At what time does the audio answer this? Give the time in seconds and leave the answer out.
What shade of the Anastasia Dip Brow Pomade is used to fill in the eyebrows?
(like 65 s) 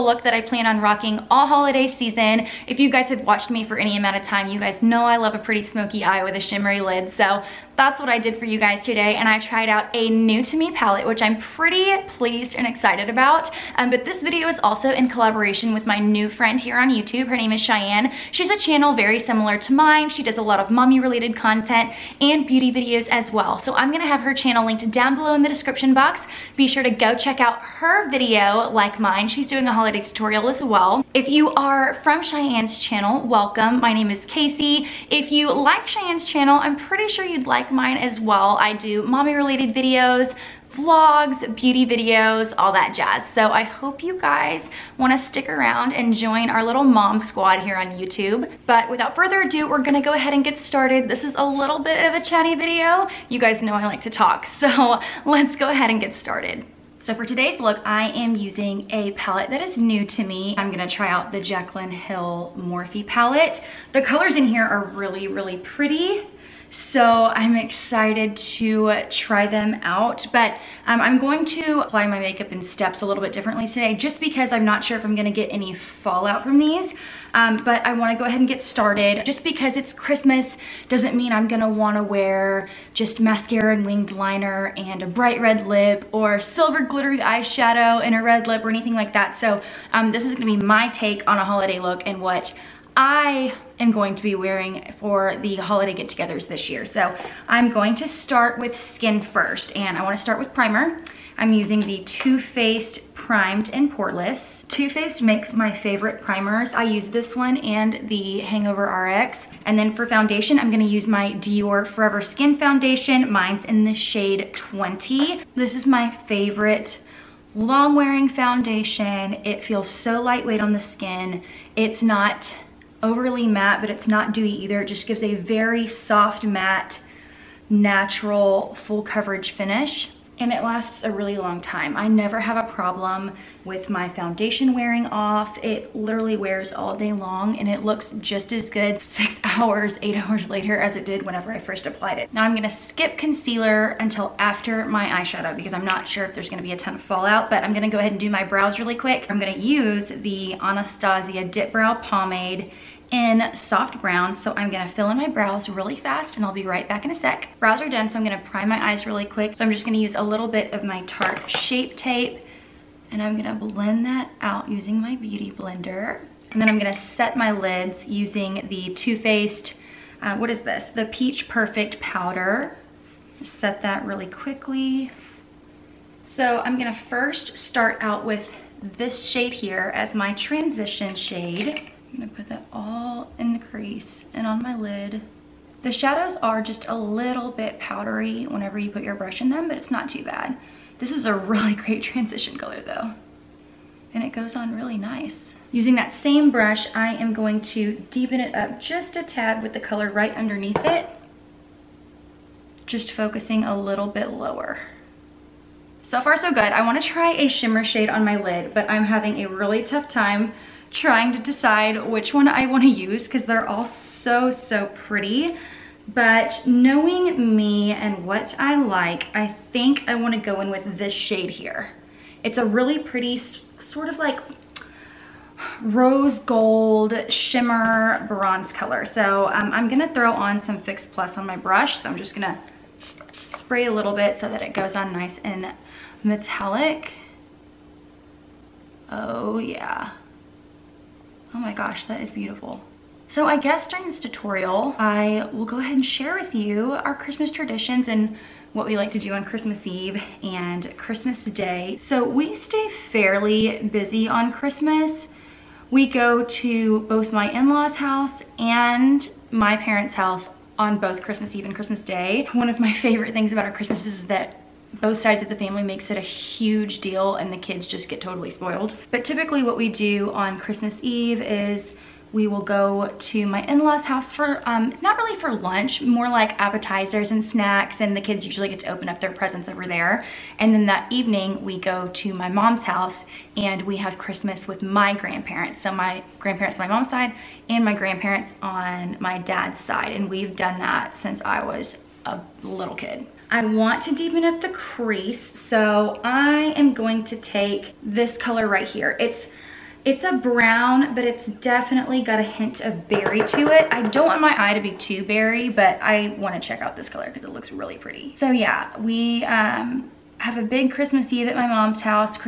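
153 s.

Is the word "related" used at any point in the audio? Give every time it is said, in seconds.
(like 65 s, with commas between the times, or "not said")
20 s, 39 s.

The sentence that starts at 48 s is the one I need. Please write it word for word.
But without further ado, we're gonna go ahead and get started.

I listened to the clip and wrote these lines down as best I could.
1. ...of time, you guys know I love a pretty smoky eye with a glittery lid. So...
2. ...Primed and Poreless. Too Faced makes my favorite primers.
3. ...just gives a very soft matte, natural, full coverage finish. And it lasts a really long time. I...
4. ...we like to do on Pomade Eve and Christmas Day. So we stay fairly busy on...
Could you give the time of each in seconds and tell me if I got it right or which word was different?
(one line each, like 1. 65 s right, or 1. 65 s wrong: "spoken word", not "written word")
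1. 4 s wrong: "shimmery", not "glittery"
2. 103 s right
3. 124 s right
4. 248 s wrong: "Christmas", not "Pomade".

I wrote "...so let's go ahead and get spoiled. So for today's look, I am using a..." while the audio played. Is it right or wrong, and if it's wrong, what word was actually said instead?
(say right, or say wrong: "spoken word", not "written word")
wrong: "started", not "spoiled".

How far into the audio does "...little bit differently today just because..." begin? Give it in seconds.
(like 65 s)
73 s.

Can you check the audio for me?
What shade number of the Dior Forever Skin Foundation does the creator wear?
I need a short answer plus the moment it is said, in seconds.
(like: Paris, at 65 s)
20, at 113 s.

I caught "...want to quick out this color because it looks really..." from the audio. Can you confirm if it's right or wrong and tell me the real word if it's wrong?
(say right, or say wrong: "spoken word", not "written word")
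wrong: "check", not "quick".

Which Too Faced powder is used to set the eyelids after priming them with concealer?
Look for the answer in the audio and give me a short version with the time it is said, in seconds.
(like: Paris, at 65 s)
Peach Perfect Powder, at 171 s.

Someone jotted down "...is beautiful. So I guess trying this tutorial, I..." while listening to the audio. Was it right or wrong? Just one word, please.
wrong.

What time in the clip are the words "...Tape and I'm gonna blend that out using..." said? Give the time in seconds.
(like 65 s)
161 s.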